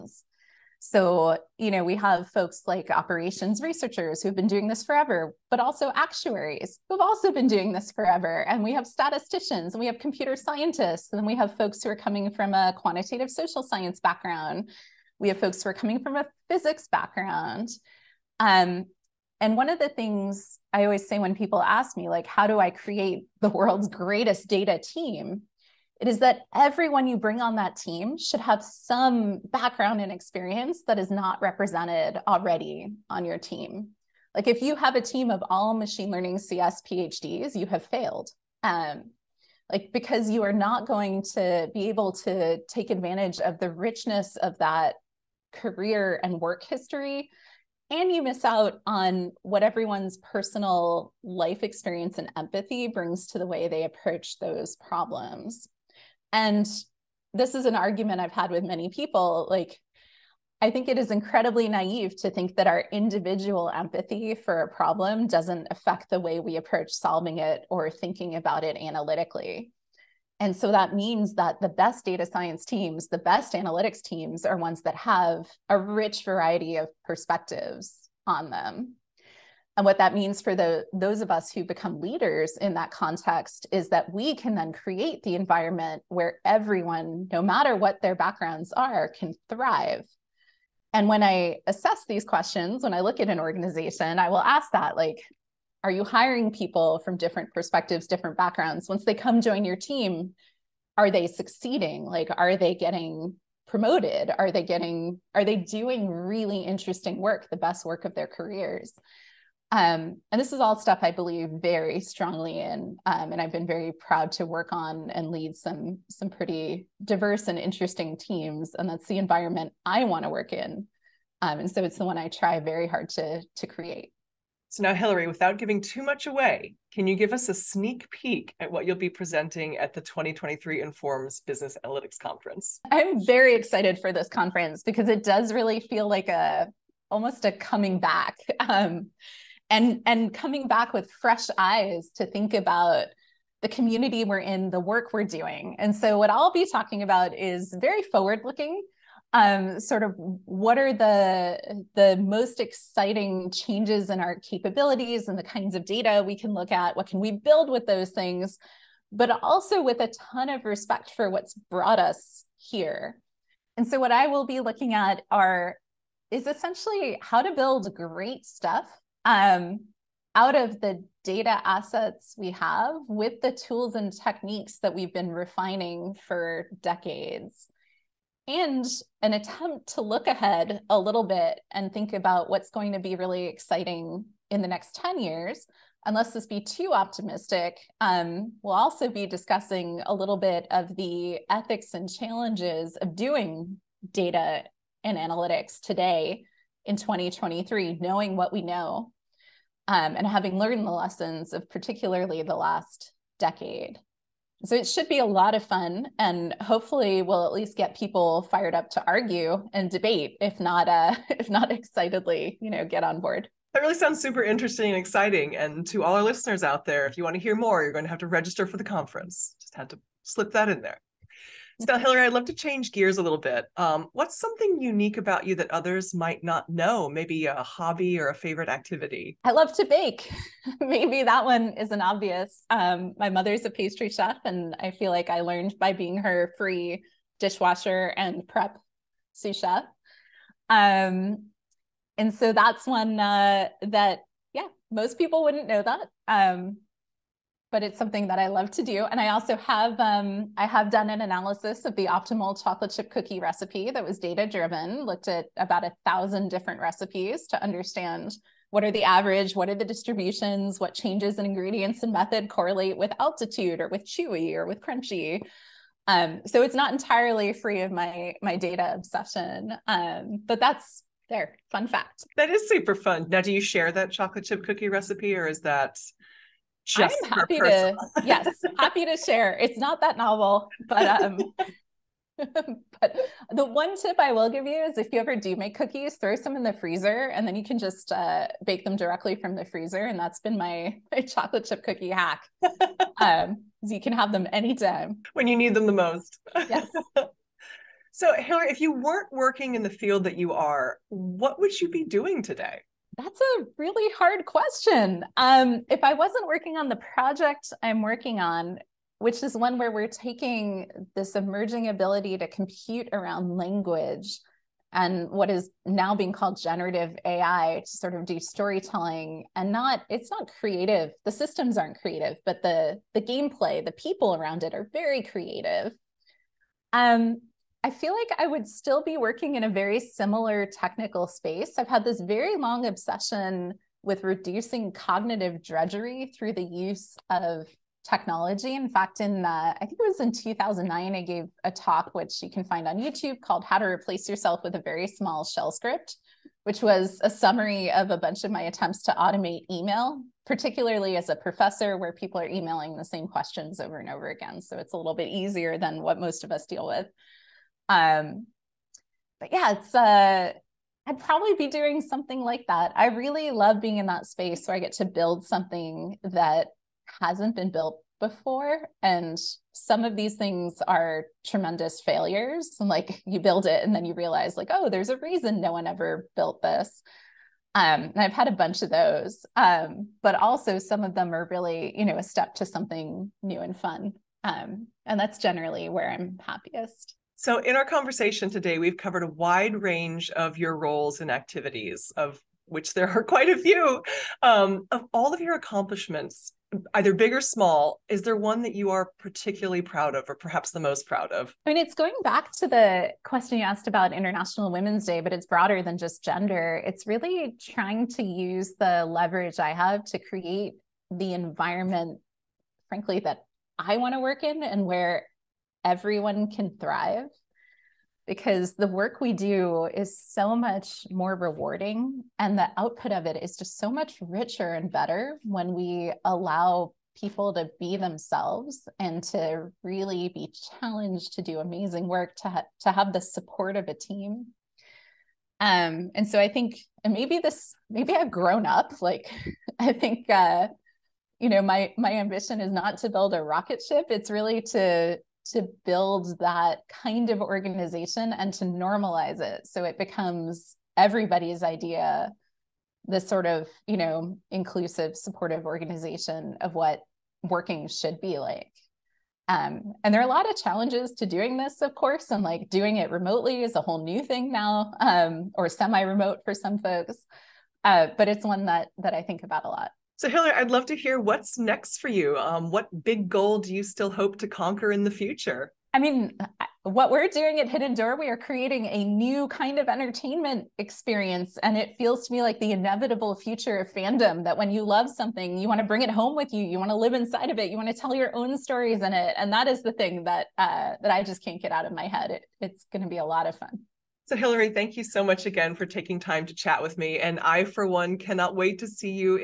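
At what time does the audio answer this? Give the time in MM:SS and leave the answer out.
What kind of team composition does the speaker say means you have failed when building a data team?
00:34.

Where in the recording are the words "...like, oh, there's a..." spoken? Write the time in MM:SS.
06:14.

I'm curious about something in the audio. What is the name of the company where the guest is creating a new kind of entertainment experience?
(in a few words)
Hidden Door.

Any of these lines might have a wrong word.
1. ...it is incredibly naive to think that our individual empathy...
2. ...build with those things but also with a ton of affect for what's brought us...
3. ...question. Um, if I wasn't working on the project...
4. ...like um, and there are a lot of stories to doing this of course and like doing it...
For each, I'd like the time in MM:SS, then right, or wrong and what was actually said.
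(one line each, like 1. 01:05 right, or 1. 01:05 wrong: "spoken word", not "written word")
1. 01:00 right
2. 02:37 wrong: "respect", not "affect"
3. 05:04 right
4. 07:38 wrong: "challenges", not "stories".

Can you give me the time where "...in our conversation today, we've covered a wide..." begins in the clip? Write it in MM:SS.
06:27.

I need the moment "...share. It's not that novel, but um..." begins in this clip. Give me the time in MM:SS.
04:39.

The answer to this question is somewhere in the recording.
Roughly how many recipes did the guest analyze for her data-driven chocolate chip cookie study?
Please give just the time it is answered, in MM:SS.
04:15.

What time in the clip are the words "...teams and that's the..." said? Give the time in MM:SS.
01:58.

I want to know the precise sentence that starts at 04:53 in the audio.
um, you can have them anytime when you need them the most.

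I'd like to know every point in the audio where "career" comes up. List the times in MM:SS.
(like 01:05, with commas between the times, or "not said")
00:45, 01:48.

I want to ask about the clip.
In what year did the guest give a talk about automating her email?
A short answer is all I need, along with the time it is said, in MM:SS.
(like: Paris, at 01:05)
2009, at 05:40.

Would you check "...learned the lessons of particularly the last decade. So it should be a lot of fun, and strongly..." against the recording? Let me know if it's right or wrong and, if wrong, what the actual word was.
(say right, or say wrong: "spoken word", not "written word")
wrong: "hopefully", not "strongly".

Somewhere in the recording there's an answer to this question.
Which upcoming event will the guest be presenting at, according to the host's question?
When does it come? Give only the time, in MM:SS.
02:10.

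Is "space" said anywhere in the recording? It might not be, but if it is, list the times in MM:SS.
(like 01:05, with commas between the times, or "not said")
05:31, 06:04.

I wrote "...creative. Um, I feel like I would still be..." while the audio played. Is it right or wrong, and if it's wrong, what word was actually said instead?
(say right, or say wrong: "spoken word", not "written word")
right.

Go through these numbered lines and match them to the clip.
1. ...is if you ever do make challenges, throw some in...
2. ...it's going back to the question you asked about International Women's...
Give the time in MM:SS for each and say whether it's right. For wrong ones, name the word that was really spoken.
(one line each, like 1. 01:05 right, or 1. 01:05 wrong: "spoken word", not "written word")
1. 04:44 wrong: "cookies", not "challenges"
2. 06:41 right.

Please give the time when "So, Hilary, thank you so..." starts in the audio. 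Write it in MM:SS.
08:14.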